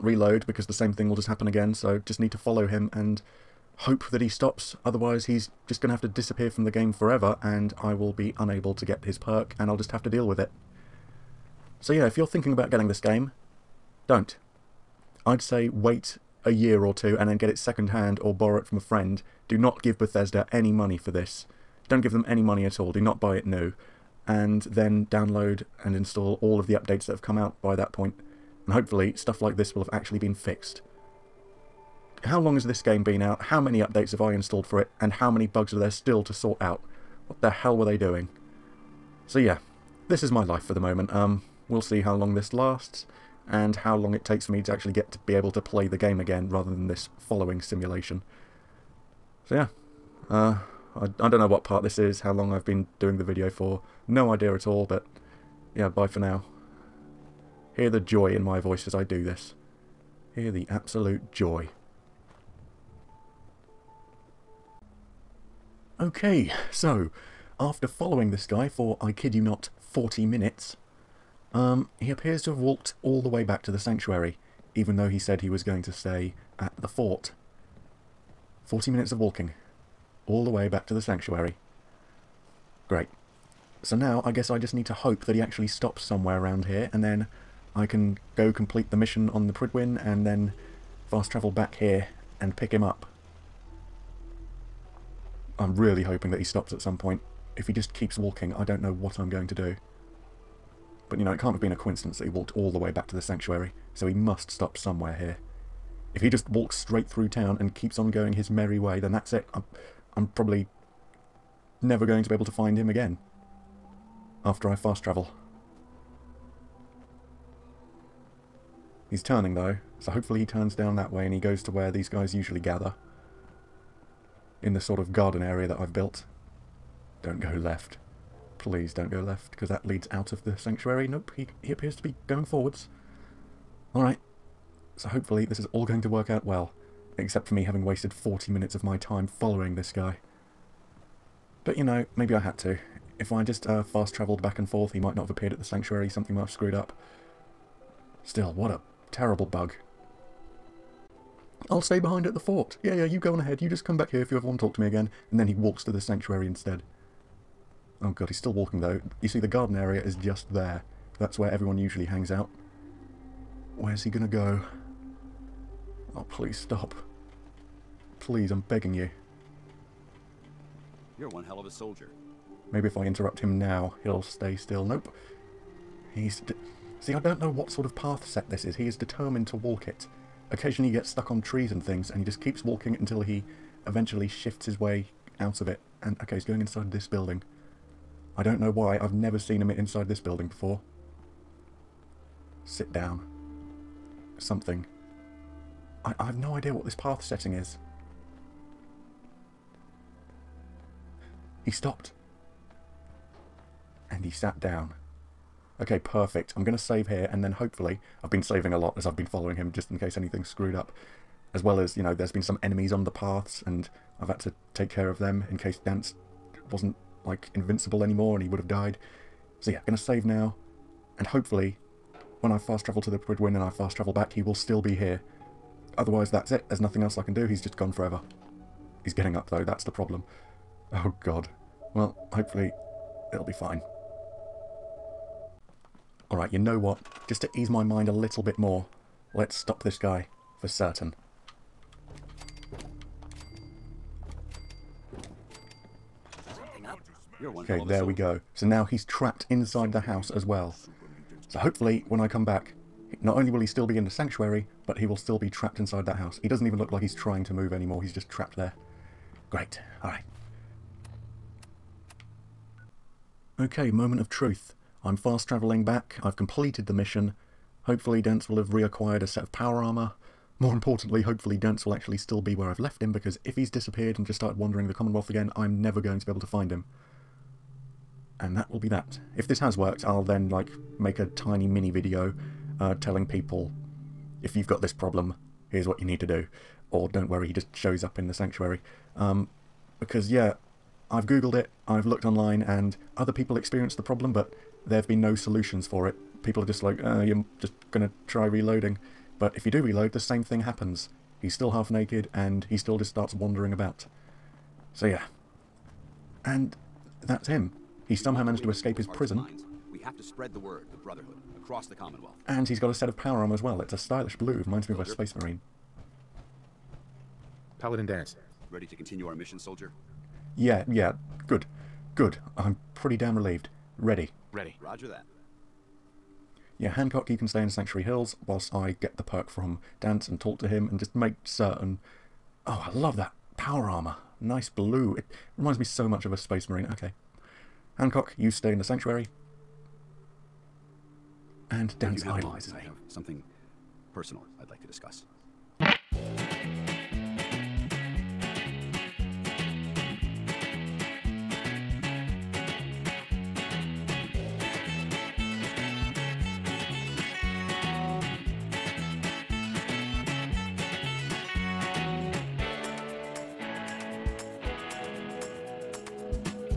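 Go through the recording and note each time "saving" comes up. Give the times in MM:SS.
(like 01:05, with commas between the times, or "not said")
03:28.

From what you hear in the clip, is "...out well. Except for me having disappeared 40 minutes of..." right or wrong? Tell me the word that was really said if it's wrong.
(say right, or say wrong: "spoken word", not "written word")
wrong: "wasted", not "disappeared".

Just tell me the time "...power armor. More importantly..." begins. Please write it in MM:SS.
04:29.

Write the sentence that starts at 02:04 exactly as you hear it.
In the sort of garden area that I've built.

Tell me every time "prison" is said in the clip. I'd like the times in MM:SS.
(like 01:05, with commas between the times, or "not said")
05:09.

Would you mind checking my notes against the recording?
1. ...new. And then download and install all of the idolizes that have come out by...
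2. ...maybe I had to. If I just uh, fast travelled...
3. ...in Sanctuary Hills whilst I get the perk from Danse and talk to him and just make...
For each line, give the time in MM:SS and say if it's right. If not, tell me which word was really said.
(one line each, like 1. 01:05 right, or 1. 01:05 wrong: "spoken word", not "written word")
1. 00:23 wrong: "updates", not "idolizes"
2. 02:22 right
3. 05:27 right.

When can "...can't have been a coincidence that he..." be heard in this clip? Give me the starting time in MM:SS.
01:41.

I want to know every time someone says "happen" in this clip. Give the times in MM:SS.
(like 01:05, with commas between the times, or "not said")
00:01, 05:00.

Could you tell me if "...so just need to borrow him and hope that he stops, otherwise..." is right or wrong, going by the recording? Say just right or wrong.
wrong.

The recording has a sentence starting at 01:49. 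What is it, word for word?
I'm, I'm probably never going to be able to find him again after I fast travel.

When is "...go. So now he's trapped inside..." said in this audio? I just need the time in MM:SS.
04:08.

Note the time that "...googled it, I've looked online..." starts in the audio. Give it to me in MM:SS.
04:51.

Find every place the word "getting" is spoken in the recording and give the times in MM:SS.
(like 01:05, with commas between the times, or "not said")
00:12, 03:49.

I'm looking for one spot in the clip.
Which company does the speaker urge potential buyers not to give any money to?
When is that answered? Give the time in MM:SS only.
00:19.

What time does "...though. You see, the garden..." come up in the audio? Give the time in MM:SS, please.
02:38.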